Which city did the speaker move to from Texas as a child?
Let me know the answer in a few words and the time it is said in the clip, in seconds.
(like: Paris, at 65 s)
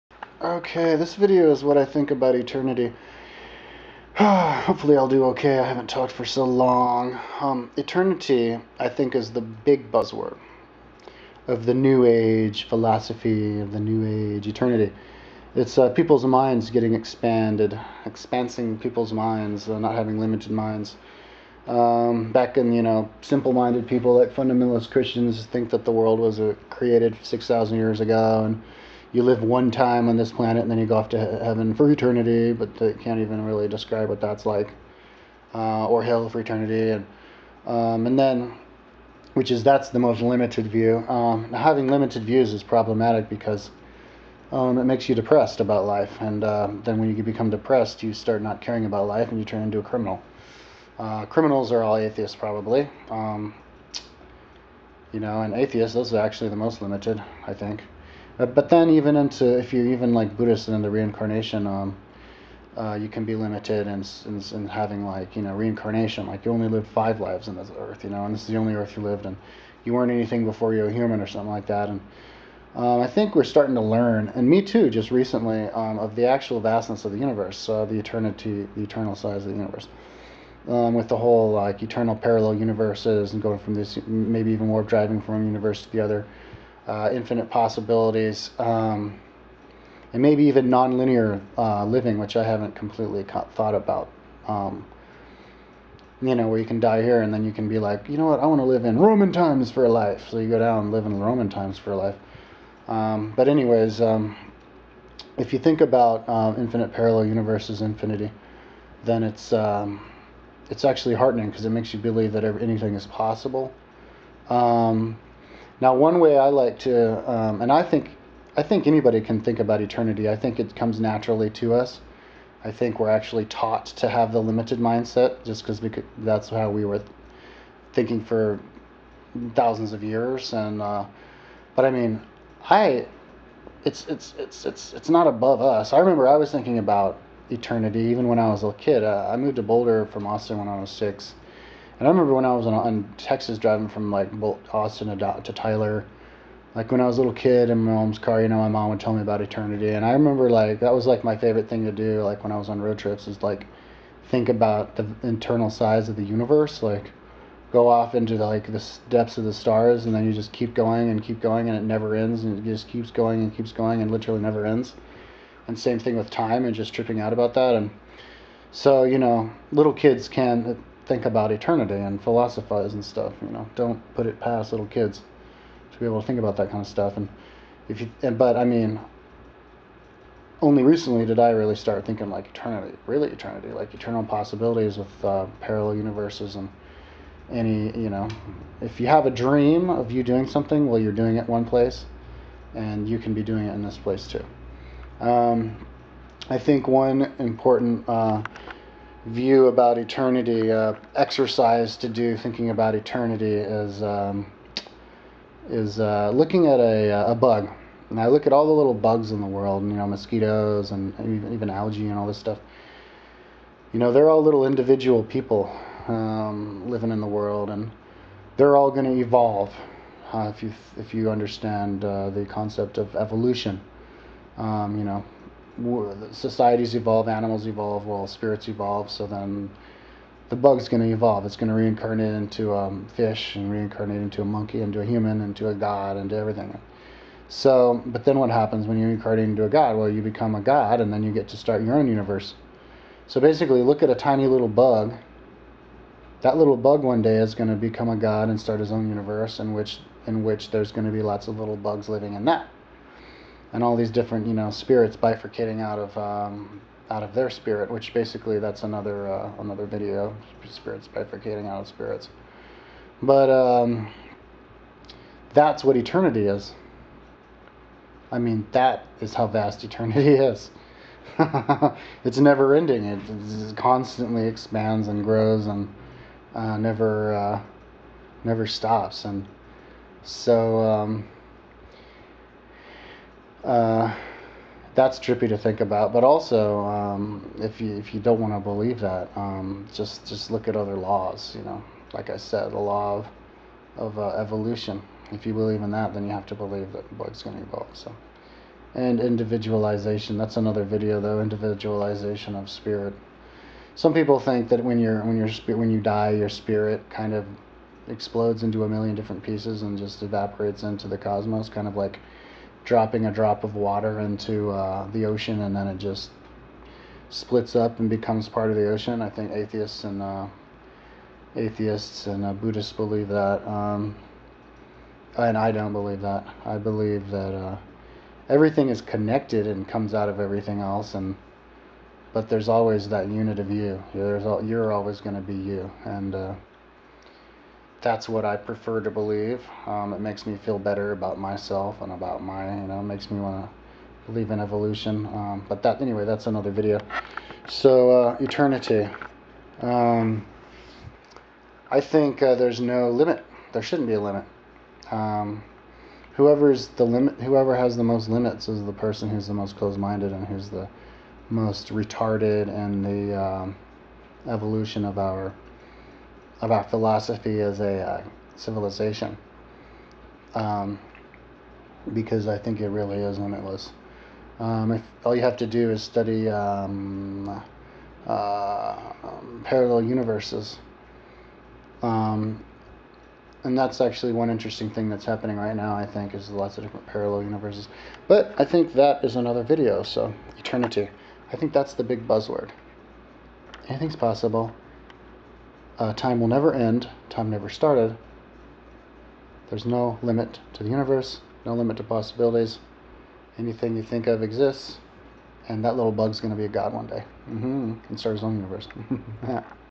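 Boulder, at 139 s.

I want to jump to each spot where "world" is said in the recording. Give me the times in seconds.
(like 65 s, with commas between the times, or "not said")
25 s, 209 s, 217 s.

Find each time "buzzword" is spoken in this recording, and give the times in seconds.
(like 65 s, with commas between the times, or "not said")
9 s, 392 s.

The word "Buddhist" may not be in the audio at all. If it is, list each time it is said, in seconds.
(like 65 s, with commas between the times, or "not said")
60 s, 322 s.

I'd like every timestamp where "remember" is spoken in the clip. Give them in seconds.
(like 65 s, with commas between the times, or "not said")
135 s, 142 s, 150 s.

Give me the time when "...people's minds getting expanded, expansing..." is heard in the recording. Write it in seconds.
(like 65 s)
15 s.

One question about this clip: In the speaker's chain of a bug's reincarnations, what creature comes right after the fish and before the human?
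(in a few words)
monkey.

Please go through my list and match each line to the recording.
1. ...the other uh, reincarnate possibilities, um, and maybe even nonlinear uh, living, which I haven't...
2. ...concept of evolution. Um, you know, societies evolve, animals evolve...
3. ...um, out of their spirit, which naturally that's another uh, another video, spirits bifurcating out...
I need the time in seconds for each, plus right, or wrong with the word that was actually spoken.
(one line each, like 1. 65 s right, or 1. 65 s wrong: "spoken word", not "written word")
1. 85 s wrong: "infinite", not "reincarnate"
2. 222 s right
3. 256 s wrong: "basically", not "naturally".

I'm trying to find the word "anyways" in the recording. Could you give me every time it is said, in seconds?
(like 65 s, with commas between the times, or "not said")
103 s, 346 s.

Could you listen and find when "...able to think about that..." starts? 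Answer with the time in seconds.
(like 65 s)
176 s.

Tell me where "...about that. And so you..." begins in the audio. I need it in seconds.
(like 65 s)
167 s.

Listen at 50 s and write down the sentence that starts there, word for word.
Uh, criminals are all atheists probably.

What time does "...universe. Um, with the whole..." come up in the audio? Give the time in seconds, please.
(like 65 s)
79 s.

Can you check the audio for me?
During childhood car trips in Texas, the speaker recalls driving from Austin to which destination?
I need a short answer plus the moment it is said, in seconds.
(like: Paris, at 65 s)
Tyler, at 145 s.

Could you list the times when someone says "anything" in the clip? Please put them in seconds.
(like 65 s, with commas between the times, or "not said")
70 s, 112 s, 393 s, 403 s.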